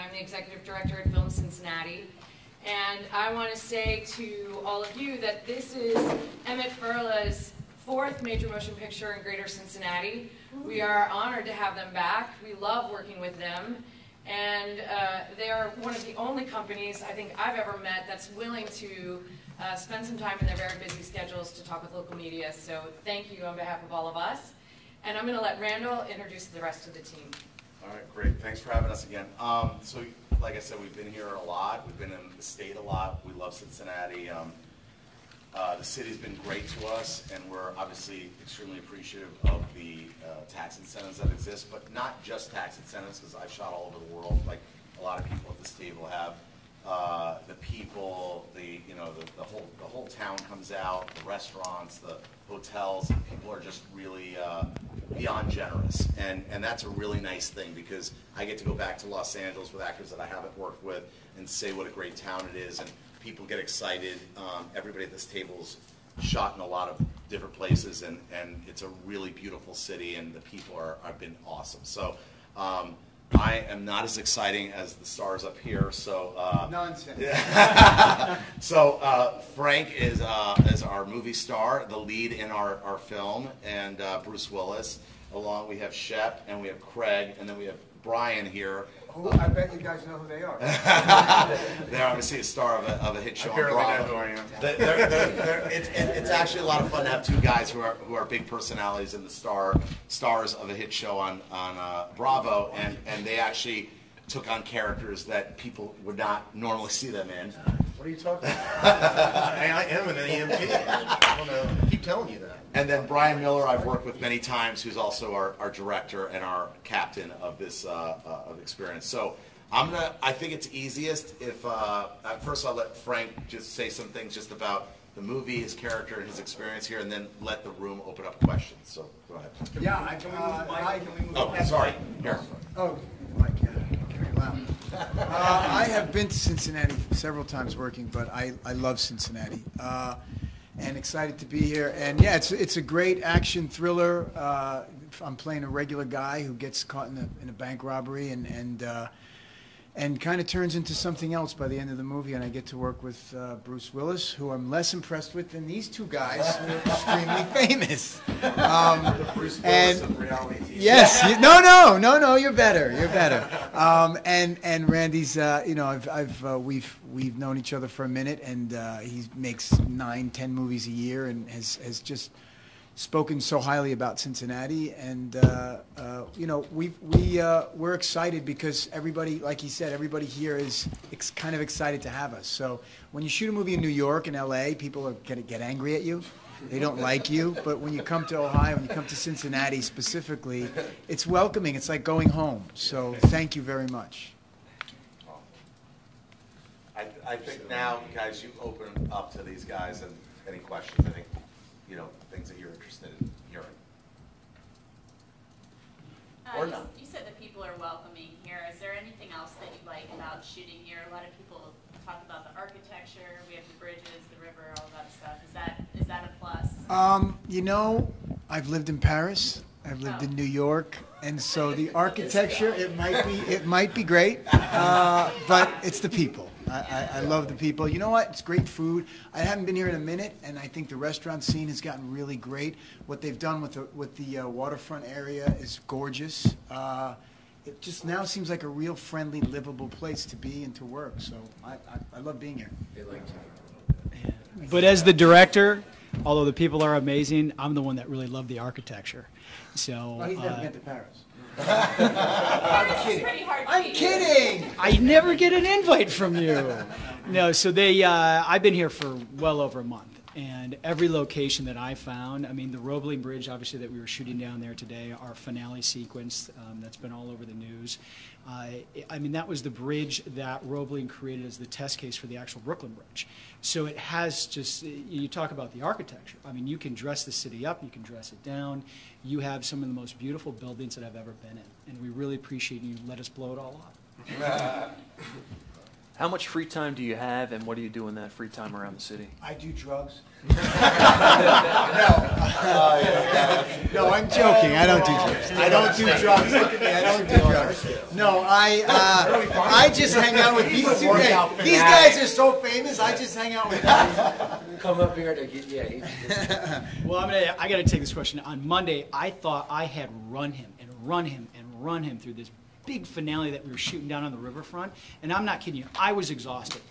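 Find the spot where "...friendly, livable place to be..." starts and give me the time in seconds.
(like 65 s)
238 s.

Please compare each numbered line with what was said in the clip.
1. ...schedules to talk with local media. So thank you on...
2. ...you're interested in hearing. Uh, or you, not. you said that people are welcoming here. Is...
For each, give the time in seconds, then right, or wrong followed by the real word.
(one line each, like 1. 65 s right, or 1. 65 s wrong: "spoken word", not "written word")
1. 21 s right
2. 202 s right.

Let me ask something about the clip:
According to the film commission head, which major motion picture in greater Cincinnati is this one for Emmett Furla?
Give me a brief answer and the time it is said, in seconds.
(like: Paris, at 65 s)
4th, at 7 s.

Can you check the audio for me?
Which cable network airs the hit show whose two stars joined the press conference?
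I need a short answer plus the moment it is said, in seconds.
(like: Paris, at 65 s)
Bravo, at 102 s.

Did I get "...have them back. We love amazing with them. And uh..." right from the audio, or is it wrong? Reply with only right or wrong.
wrong.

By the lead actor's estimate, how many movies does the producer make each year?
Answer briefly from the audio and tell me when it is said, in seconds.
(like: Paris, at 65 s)
9 to 10, at 169 s.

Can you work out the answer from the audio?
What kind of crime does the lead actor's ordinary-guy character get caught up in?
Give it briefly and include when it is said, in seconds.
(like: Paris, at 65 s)
Bank robbery, at 147 s.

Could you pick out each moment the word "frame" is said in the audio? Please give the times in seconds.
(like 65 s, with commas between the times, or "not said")
not said.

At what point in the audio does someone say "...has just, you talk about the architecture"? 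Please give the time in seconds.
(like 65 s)
273 s.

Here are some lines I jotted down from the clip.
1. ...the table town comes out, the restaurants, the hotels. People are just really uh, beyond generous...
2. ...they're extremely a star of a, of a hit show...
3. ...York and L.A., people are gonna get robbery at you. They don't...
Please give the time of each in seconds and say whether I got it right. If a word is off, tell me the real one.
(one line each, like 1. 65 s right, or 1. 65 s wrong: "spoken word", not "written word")
1. 49 s wrong: "whole", not "table"
2. 91 s wrong: "obviously", not "extremely"
3. 183 s wrong: "angry", not "robbery".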